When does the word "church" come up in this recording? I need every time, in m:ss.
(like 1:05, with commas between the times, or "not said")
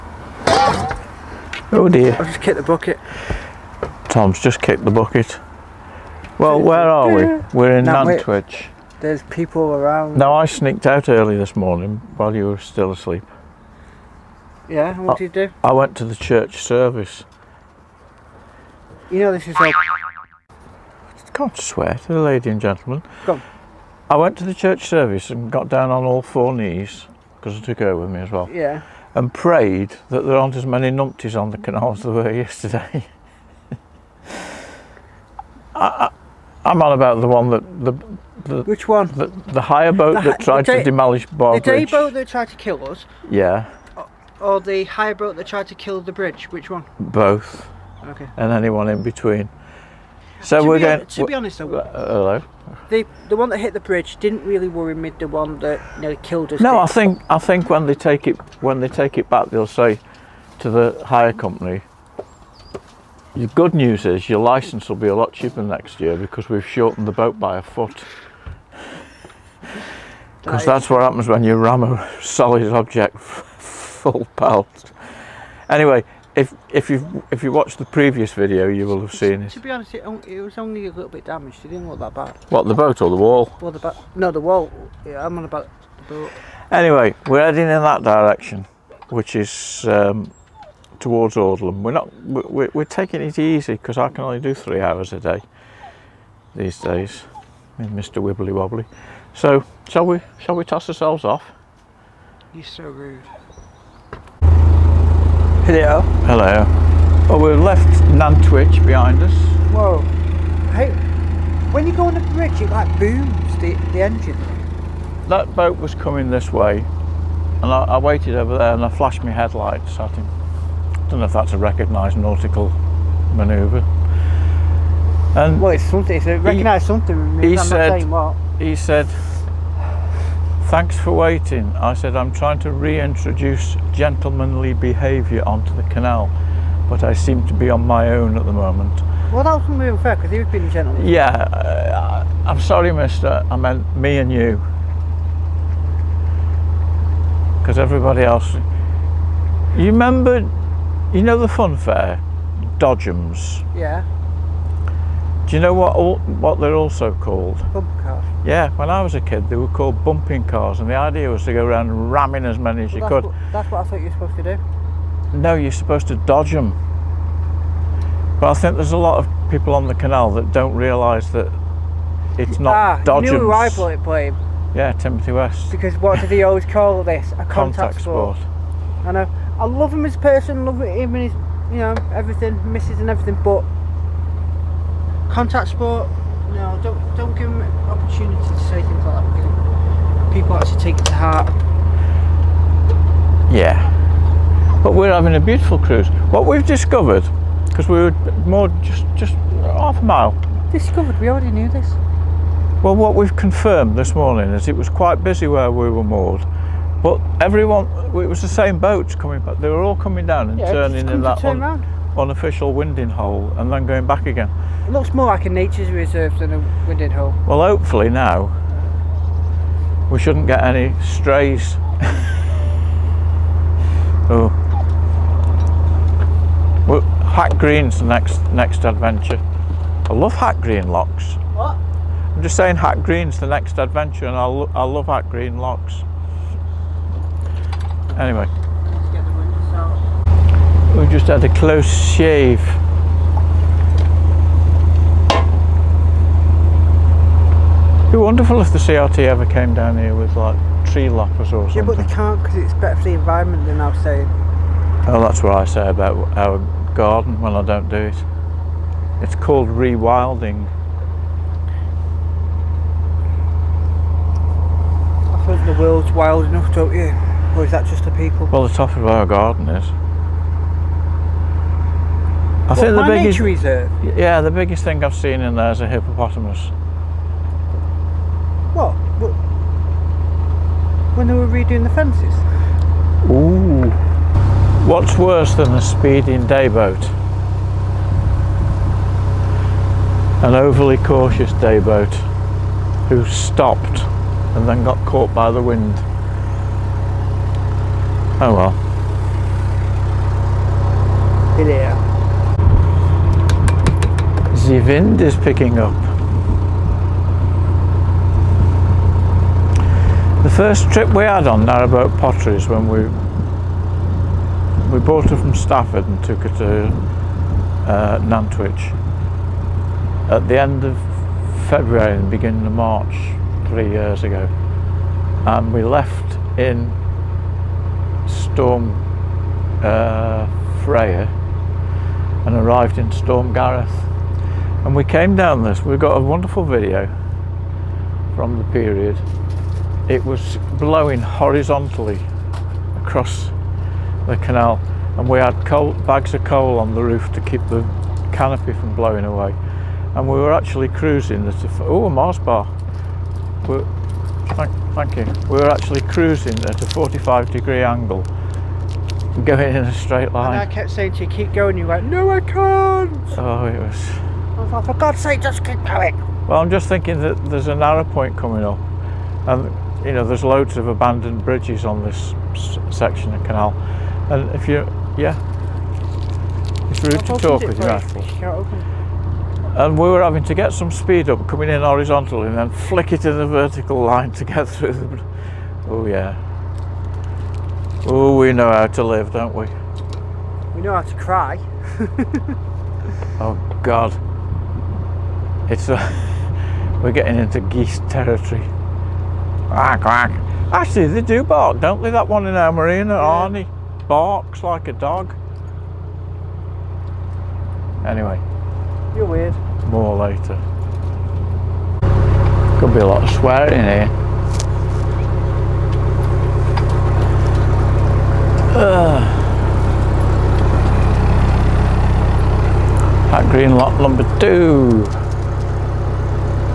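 0:16, 0:24.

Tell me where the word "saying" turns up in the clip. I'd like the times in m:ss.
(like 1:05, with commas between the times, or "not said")
3:52, 6:00.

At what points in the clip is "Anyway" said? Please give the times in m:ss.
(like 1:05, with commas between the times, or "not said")
1:15, 1:26, 3:58, 6:48.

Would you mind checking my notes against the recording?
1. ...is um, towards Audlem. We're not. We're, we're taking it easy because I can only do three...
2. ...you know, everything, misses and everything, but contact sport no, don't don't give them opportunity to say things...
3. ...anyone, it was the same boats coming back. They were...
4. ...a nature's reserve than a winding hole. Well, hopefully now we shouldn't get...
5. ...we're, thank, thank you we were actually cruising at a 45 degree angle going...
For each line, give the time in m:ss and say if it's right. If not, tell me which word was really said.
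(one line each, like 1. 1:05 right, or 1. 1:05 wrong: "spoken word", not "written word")
1. 1:29 right
2. 3:01 right
3. 3:27 wrong: "everyone", not "anyone"
4. 3:35 right
5. 5:53 right.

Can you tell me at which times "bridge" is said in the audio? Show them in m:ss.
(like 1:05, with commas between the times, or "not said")
0:41, 0:46, 0:53, 1:52, 6:11.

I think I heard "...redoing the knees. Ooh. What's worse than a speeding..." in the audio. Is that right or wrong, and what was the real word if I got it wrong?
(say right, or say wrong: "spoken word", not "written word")
wrong: "fences", not "knees".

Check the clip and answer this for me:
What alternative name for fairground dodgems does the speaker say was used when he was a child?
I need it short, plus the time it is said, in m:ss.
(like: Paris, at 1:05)
bumping cars, at 2:40.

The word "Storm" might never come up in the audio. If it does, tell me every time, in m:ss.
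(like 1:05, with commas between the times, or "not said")
5:28, 5:33.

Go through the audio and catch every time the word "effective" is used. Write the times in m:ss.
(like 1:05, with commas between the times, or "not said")
not said.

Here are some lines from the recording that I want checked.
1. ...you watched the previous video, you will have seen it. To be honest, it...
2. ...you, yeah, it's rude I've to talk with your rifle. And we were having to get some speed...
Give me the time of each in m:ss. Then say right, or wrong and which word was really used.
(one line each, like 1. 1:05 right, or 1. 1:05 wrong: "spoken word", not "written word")
1. 1:17 right
2. 6:14 right.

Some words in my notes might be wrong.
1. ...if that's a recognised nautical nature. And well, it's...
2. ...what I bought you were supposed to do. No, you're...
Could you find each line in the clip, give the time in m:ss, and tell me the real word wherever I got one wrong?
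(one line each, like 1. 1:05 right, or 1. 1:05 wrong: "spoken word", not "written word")
1. 2:01 wrong: "manoeuvre", not "nature"
2. 2:43 wrong: "thought", not "bought".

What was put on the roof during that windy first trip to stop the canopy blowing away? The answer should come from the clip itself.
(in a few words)
bags of coal.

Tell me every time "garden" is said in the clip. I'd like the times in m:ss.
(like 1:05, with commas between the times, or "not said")
4:16, 4:29.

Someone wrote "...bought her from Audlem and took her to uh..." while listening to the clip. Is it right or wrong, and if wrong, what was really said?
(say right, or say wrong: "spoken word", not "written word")
wrong: "Stafford", not "Audlem".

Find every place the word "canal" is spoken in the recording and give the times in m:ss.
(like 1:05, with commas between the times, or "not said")
0:31, 2:15, 2:49, 5:44, 6:13.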